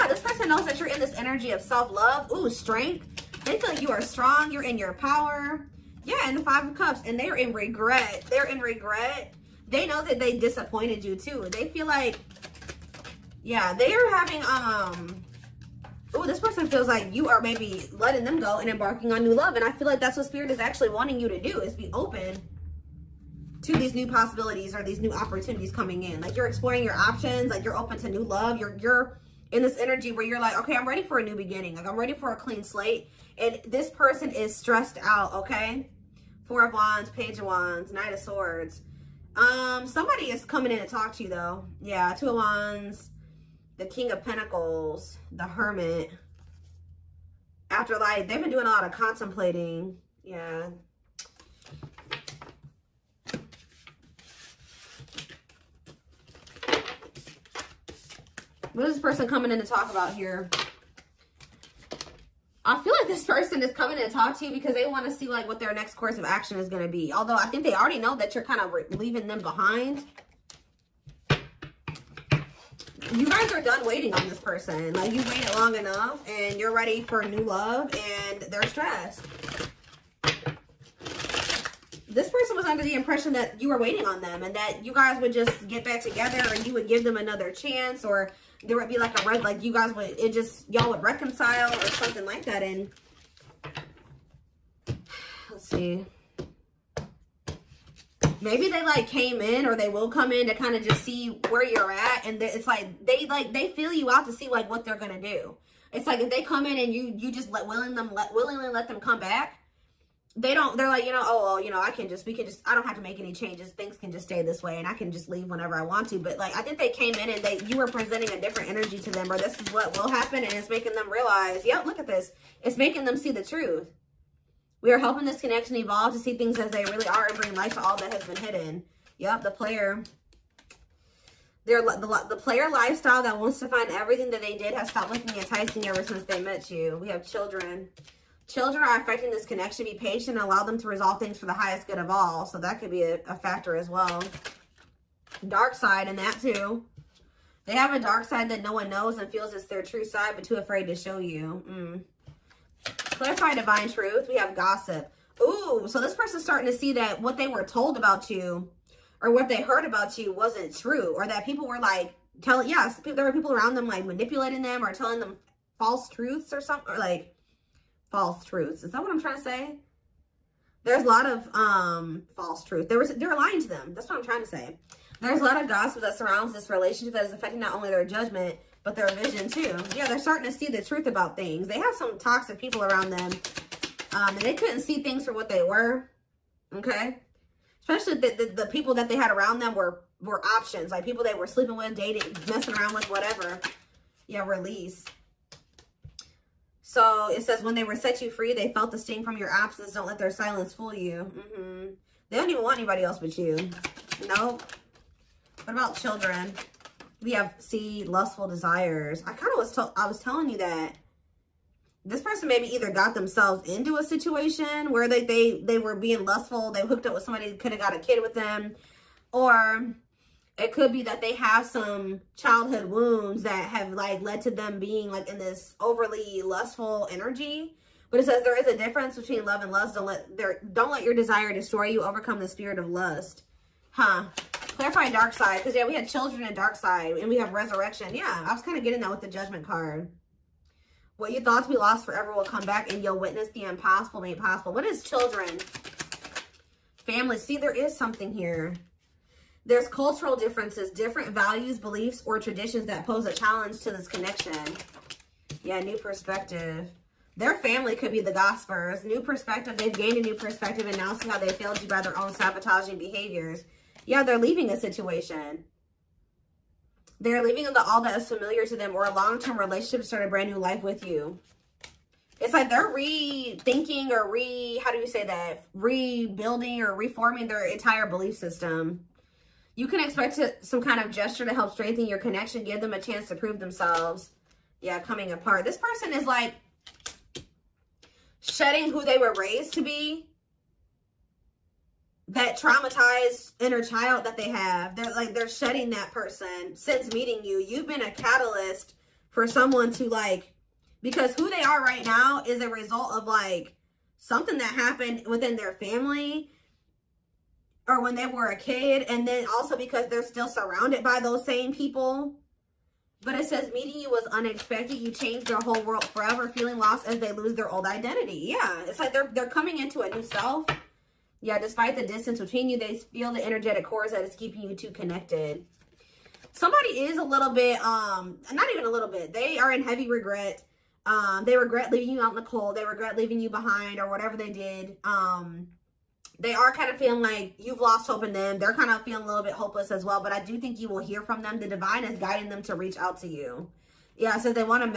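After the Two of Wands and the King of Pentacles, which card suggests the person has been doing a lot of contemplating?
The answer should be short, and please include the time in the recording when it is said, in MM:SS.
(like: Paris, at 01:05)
The Hermit, at 00:45.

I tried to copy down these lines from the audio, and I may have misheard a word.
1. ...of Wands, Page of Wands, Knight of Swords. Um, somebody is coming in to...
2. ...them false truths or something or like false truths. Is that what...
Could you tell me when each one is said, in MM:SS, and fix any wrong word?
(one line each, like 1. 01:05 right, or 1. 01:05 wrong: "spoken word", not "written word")
1. 00:36 right
2. 02:45 right.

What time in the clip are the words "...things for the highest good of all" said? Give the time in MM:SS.
02:21.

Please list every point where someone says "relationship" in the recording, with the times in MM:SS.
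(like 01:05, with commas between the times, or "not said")
02:56, 04:29.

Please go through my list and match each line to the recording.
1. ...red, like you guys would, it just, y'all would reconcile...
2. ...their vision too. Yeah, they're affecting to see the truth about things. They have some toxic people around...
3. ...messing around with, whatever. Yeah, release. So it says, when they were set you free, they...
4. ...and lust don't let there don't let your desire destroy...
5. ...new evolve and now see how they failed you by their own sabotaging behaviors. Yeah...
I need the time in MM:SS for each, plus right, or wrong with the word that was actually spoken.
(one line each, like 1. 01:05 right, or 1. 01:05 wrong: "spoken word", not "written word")
1. 01:29 right
2. 02:58 wrong: "starting", not "affecting"
3. 03:12 right
4. 03:49 right
5. 04:20 wrong: "perspective", not "evolve".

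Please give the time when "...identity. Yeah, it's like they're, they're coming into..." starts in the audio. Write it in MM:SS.
05:17.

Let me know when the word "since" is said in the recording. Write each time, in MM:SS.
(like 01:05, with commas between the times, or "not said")
02:16, 04:56.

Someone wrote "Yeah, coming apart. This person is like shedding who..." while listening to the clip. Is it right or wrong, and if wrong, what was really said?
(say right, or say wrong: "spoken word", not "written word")
right.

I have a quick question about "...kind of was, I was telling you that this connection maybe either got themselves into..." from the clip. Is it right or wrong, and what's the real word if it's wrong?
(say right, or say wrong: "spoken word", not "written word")
wrong: "person", not "connection".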